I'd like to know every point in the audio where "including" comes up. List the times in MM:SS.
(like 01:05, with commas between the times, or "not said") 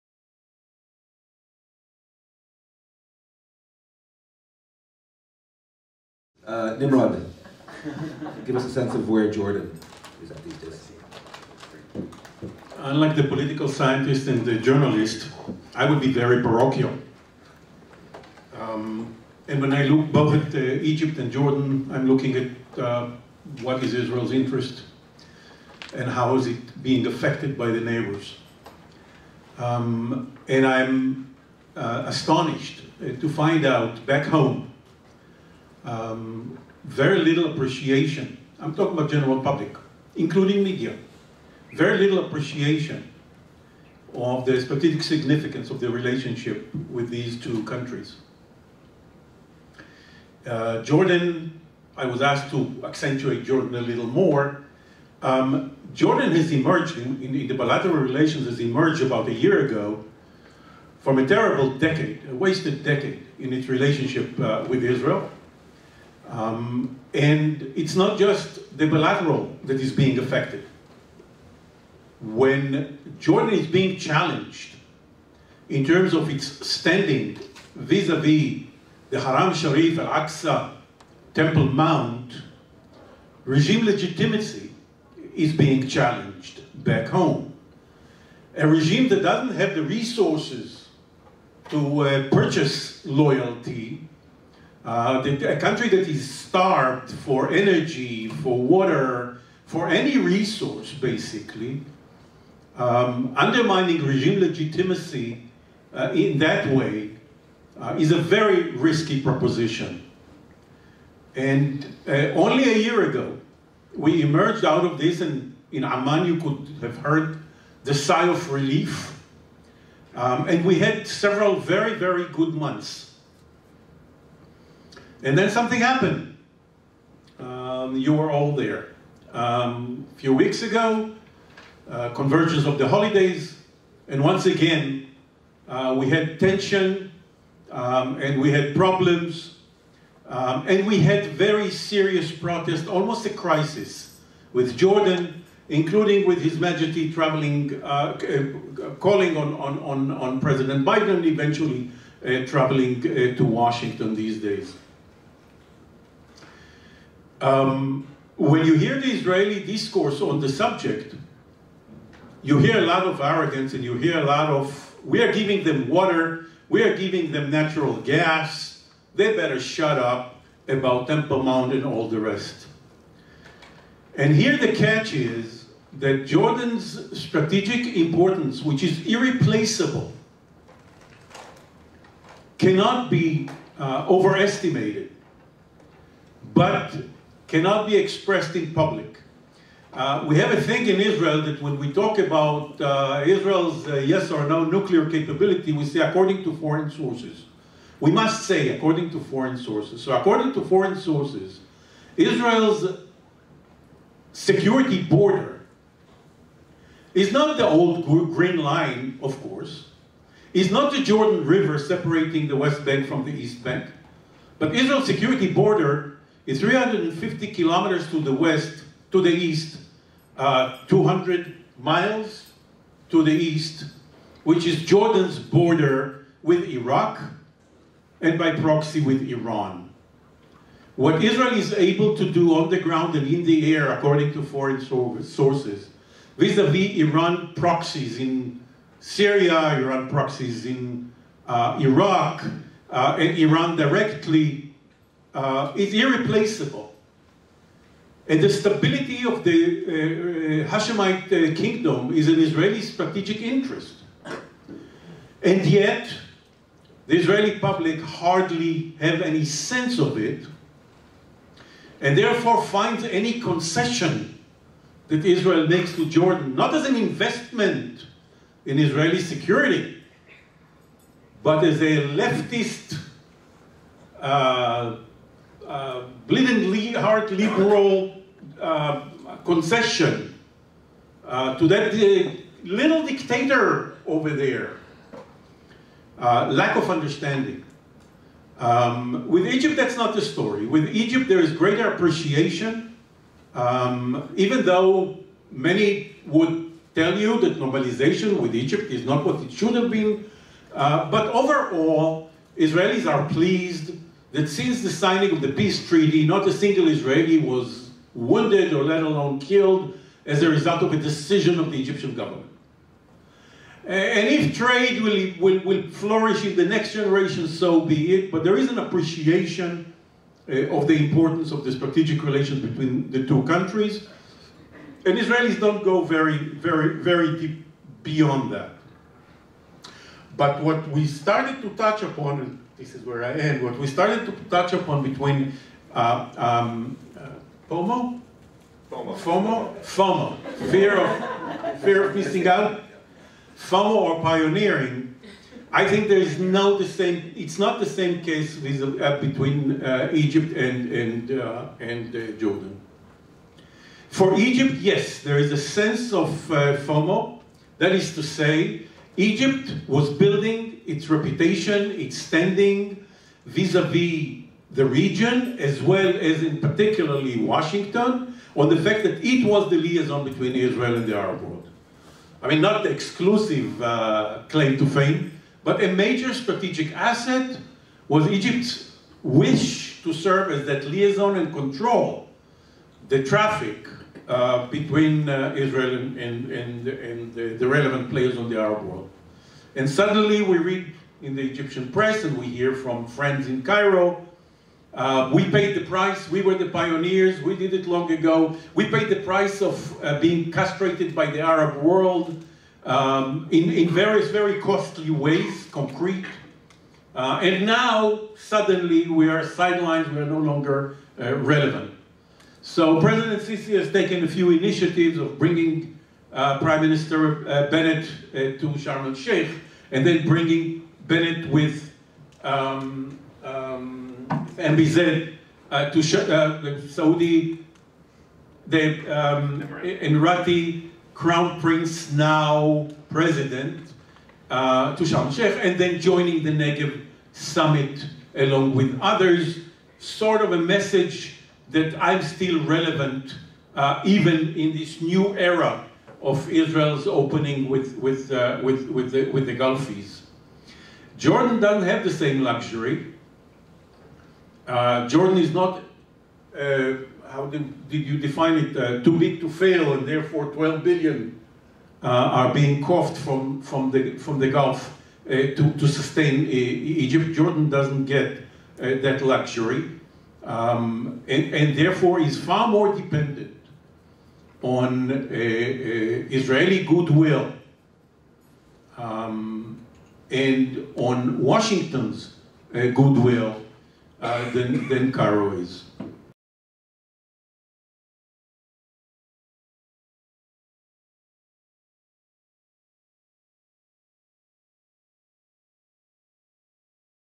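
00:40, 02:25.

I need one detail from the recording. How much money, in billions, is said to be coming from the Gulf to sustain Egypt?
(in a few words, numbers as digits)
12 billion.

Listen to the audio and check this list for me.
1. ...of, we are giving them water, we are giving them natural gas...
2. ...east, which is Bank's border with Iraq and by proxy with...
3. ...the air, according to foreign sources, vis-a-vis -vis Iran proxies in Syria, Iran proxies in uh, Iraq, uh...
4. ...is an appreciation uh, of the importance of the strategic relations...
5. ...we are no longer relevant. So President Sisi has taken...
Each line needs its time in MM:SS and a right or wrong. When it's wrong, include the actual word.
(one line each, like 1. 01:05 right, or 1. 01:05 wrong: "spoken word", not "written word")
1. 02:44 right
2. 03:43 wrong: "Jordan", not "Bank"
3. 03:53 right
4. 05:18 right
5. 06:50 right.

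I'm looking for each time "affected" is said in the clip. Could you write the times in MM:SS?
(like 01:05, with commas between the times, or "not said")
00:27, 01:10.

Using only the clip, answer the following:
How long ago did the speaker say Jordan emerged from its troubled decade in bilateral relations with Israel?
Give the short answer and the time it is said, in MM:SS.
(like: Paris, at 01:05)
about a year ago, at 00:59.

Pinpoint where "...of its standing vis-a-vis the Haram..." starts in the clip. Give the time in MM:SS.
01:16.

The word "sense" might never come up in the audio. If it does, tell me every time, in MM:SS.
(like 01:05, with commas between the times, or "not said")
00:08, 04:19, 05:55.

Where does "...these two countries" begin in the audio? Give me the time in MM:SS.
00:47.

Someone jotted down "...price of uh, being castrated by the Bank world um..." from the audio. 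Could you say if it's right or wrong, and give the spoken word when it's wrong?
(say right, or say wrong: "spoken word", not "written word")
wrong: "Arab", not "Bank".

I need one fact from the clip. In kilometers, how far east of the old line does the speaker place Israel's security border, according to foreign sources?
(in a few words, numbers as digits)
350 kilometers.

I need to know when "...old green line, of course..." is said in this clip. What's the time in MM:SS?
03:27.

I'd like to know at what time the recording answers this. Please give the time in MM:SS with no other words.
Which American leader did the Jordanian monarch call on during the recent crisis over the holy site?
02:30.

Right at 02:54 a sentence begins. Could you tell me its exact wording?
And here the catch is that Jordan's strategic importance, which is irreplaceable, cannot be uh, overestimated.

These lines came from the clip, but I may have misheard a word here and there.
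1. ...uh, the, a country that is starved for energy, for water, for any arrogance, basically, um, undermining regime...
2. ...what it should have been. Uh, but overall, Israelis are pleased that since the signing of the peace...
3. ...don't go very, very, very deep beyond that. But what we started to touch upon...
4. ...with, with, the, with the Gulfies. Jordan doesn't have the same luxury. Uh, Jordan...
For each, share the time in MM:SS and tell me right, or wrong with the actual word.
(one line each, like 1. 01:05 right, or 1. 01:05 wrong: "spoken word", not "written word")
1. 01:34 wrong: "resource", not "arrogance"
2. 04:59 right
3. 05:25 right
4. 07:28 right.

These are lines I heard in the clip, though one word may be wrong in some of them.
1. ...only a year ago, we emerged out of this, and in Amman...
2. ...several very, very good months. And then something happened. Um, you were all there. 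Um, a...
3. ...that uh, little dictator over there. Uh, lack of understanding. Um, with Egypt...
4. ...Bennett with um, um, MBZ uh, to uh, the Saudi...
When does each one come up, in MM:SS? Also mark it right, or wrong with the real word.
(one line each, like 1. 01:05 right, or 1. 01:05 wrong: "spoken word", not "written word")
1. 01:52 right
2. 02:01 right
3. 04:41 right
4. 07:01 right.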